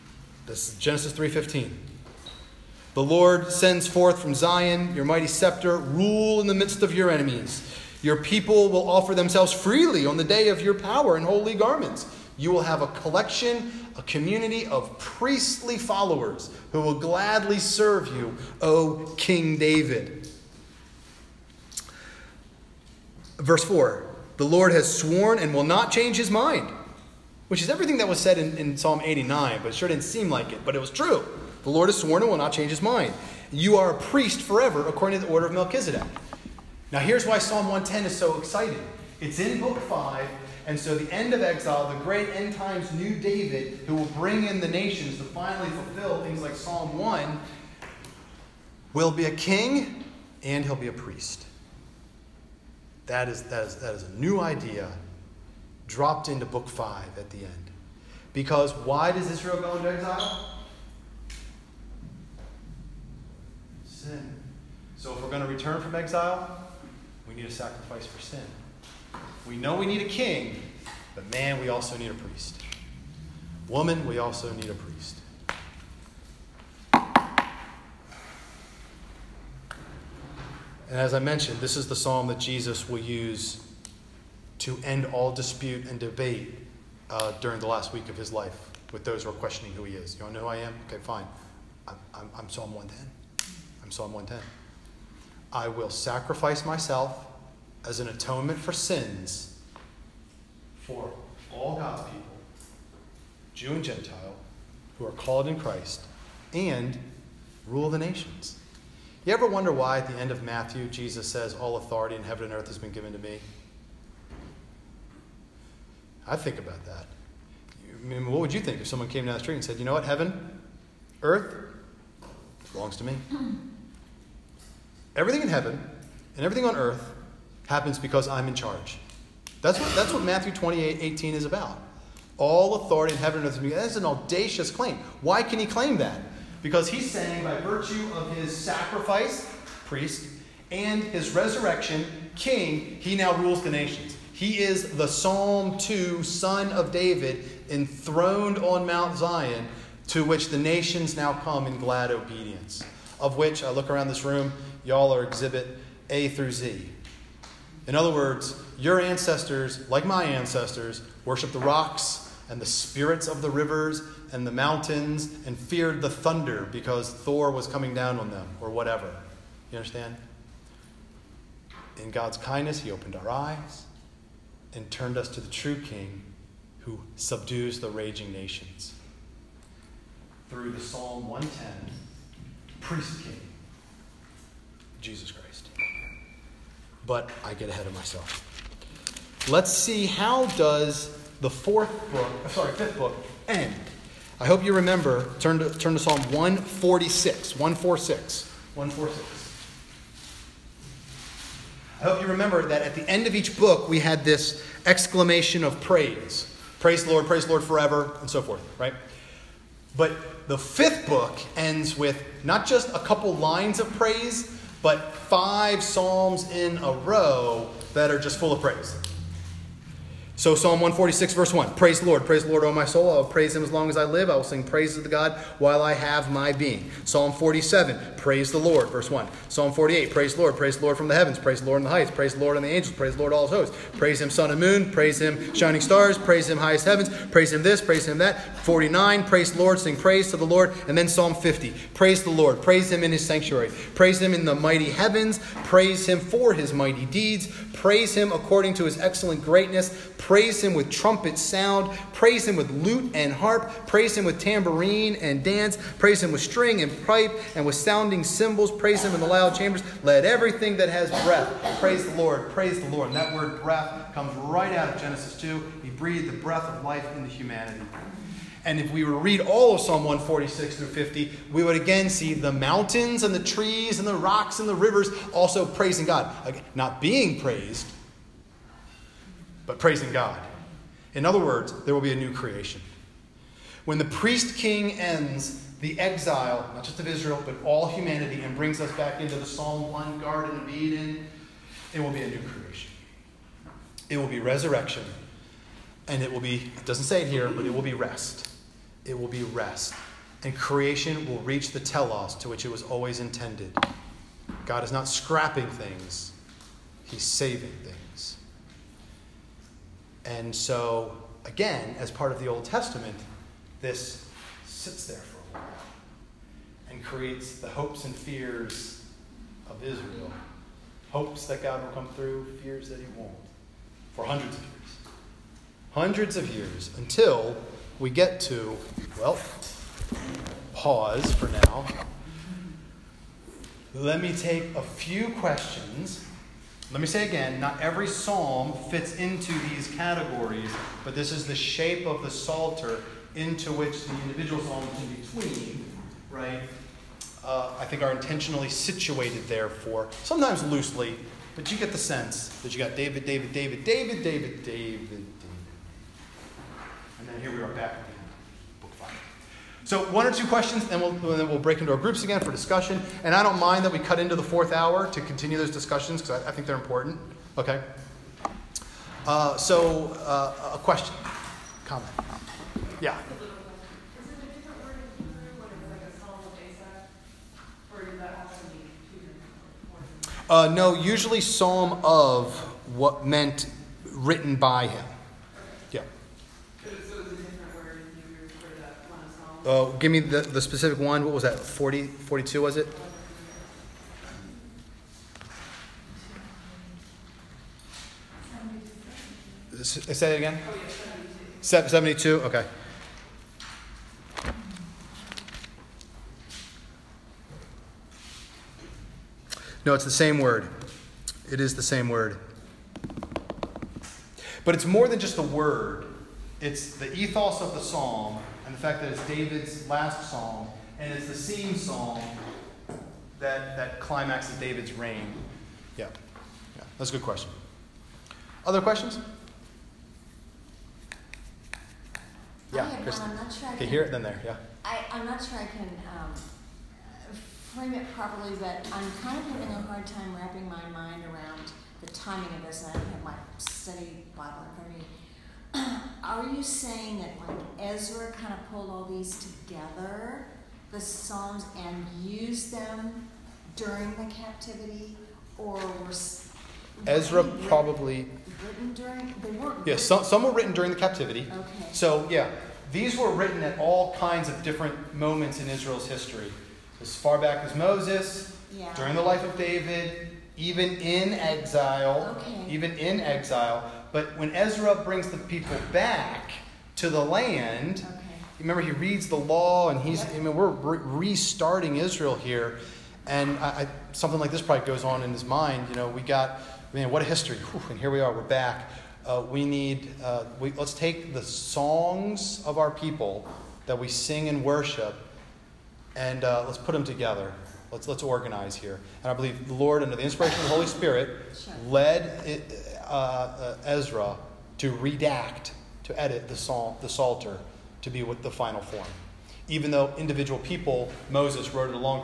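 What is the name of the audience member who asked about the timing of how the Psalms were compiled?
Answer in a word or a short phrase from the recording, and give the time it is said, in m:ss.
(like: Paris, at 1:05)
Kristen, at 7:13.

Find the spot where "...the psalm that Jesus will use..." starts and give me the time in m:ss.
1:21.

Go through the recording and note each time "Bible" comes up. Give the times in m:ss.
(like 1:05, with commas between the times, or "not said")
7:24.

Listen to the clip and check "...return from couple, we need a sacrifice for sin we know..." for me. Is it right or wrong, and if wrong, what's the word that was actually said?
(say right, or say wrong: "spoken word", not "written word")
wrong: "exile", not "couple".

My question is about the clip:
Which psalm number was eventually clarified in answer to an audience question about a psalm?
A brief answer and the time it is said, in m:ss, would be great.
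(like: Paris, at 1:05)
72, at 6:41.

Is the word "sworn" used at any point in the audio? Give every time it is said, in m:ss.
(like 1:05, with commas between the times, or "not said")
0:24, 0:31.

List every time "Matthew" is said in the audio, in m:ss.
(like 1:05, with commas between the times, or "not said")
1:50, 2:10.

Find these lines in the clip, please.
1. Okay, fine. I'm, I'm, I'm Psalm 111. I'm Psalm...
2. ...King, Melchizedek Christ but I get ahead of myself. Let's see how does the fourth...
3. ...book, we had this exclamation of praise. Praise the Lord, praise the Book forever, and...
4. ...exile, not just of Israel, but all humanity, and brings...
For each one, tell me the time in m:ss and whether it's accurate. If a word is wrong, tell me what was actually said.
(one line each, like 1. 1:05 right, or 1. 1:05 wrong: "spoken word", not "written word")
1. 1:30 wrong: "110", not "111"
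2. 3:03 wrong: "Jesus", not "Melchizedek"
3. 3:23 wrong: "Lord", not "Book"
4. 4:45 right.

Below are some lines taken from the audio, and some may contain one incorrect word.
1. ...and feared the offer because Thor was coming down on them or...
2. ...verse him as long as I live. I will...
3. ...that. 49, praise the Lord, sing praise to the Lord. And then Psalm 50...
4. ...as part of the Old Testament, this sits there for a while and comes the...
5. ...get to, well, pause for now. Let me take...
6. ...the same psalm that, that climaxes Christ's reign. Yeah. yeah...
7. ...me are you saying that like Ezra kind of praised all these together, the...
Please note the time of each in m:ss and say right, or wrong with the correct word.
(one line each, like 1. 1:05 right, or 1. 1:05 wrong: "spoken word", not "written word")
1. 2:45 wrong: "thunder", not "offer"
2. 3:43 wrong: "praise", not "verse"
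3. 3:58 right
4. 5:11 wrong: "creates", not "comes"
5. 5:28 right
6. 7:01 wrong: "David", not "Christ"
7. 7:24 wrong: "pulled", not "praised".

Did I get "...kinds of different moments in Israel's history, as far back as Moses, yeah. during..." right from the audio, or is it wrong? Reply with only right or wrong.
right.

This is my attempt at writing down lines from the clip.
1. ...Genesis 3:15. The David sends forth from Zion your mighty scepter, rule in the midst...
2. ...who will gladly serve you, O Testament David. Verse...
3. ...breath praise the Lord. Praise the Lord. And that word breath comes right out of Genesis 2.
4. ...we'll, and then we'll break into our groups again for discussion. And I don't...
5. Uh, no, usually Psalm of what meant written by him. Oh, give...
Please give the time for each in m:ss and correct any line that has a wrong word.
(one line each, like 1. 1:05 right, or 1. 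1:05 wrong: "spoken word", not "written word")
1. 0:00 wrong: "Lord", not "David"
2. 0:16 wrong: "King", not "Testament"
3. 4:21 right
4. 6:01 right
5. 6:20 right.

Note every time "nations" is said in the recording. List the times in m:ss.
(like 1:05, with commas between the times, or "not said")
0:44, 1:47, 2:23, 2:30, 2:58.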